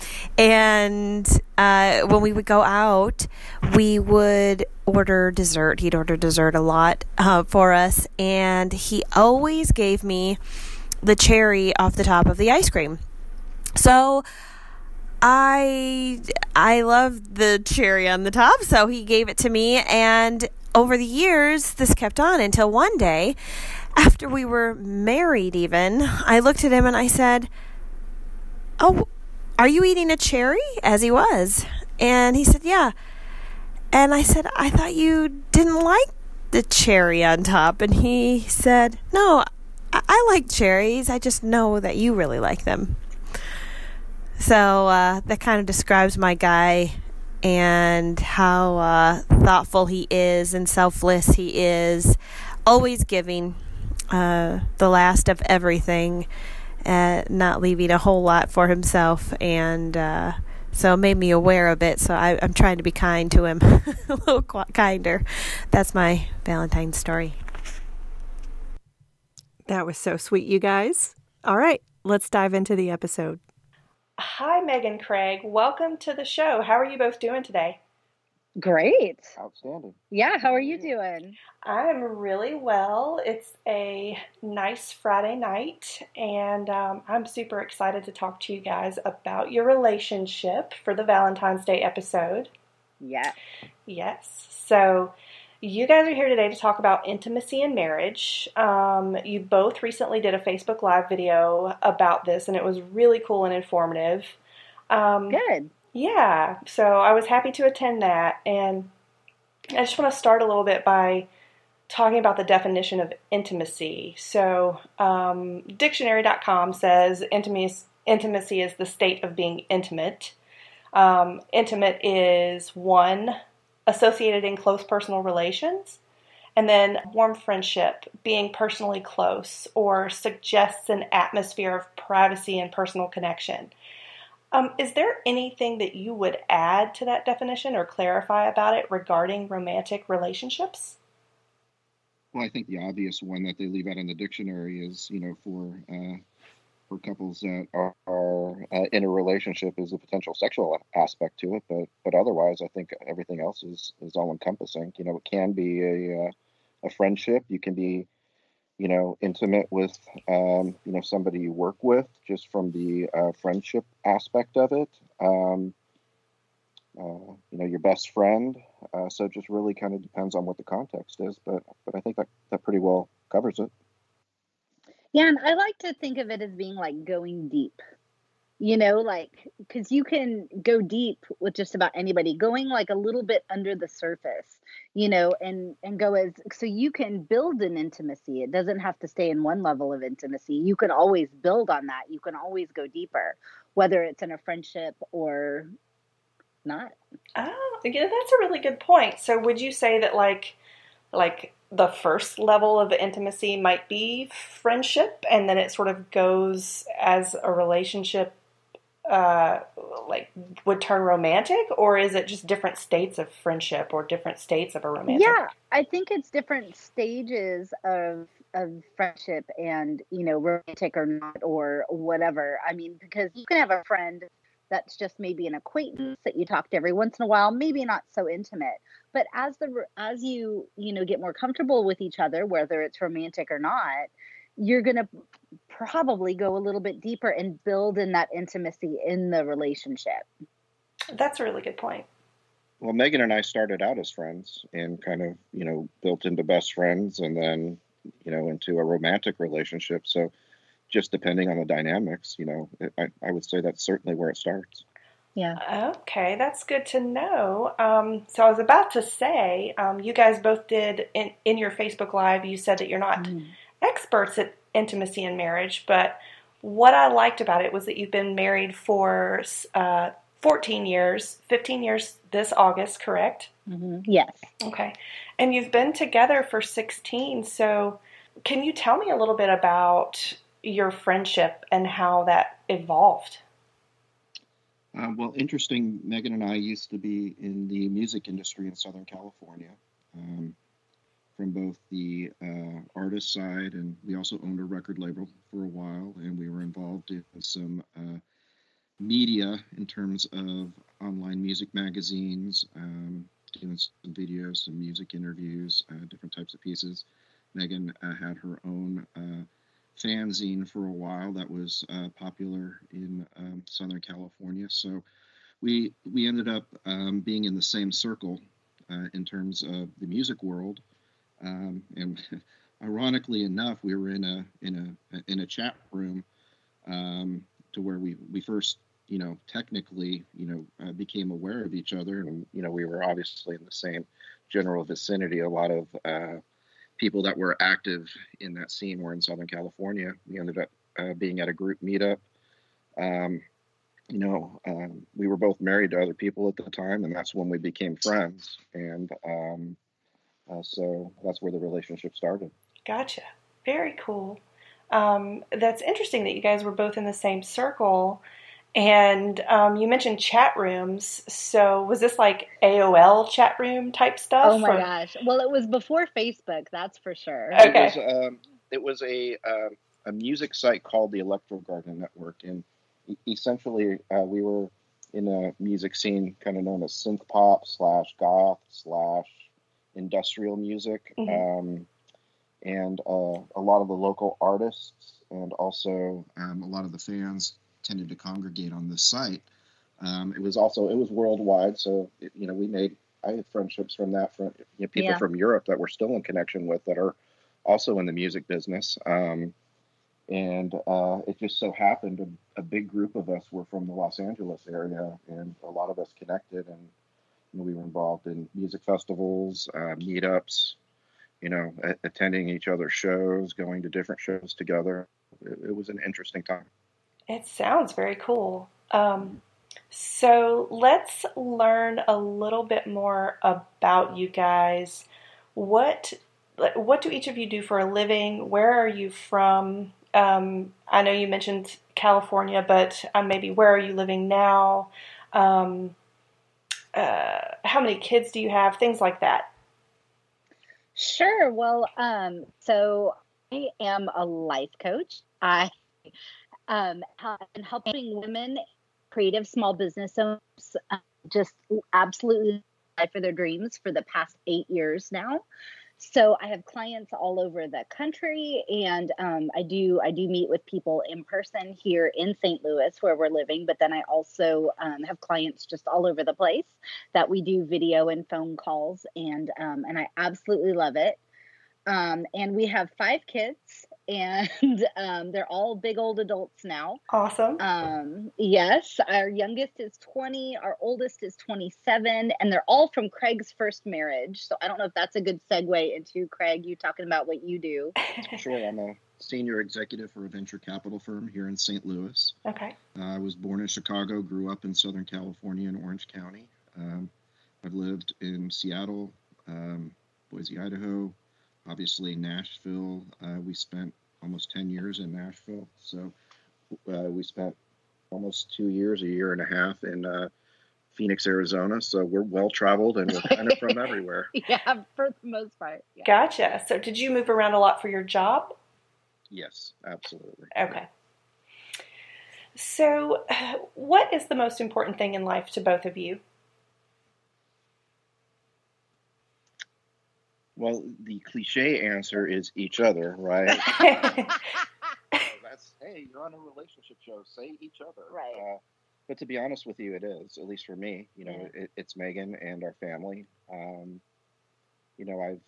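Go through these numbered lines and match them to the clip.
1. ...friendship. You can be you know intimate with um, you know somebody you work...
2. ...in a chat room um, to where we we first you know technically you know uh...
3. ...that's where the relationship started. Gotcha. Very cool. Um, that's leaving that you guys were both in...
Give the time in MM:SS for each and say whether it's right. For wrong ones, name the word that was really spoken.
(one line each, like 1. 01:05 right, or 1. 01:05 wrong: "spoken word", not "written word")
1. 02:36 right
2. 05:25 right
3. 05:51 wrong: "interesting", not "leaving".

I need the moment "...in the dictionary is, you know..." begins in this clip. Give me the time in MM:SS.
02:23.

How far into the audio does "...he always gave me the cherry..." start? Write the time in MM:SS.
00:08.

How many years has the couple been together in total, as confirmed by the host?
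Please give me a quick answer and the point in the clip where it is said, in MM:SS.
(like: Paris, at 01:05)
16, at 04:36.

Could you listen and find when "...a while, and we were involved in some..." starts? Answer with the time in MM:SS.
04:55.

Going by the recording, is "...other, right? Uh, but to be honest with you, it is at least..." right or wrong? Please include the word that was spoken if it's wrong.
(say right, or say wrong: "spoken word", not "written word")
right.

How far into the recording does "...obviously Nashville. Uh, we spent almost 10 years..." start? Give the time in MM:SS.
08:21.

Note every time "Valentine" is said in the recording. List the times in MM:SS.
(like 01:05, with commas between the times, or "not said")
01:06, 01:31.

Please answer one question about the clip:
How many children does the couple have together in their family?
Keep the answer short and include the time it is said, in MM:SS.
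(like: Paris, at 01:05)
5, at 07:52.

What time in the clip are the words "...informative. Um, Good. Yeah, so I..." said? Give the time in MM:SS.
01:43.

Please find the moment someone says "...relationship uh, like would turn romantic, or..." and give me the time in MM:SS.
03:27.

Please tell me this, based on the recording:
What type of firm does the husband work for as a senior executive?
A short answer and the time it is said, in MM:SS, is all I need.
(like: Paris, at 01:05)
Venture capital firm, at 08:10.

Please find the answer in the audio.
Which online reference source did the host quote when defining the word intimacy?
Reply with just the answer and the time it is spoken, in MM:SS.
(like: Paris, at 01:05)
dictionary.com, at 01:55.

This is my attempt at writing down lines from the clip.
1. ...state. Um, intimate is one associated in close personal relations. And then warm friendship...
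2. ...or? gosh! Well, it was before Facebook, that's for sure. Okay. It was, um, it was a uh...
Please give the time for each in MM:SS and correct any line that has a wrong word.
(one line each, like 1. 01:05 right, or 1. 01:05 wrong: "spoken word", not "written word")
1. 01:59 wrong: "intimate", not "state"
2. 06:04 right.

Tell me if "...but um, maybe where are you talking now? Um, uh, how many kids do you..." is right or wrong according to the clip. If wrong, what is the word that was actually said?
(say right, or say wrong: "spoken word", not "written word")
wrong: "living", not "talking".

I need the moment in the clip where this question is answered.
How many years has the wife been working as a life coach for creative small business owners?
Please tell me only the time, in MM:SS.
07:34.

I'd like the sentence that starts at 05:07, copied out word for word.
Megan uh, had her own uh, fanzine for a while that was uh, popular in um, Southern California.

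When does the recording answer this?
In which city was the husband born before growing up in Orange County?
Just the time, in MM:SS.
08:13.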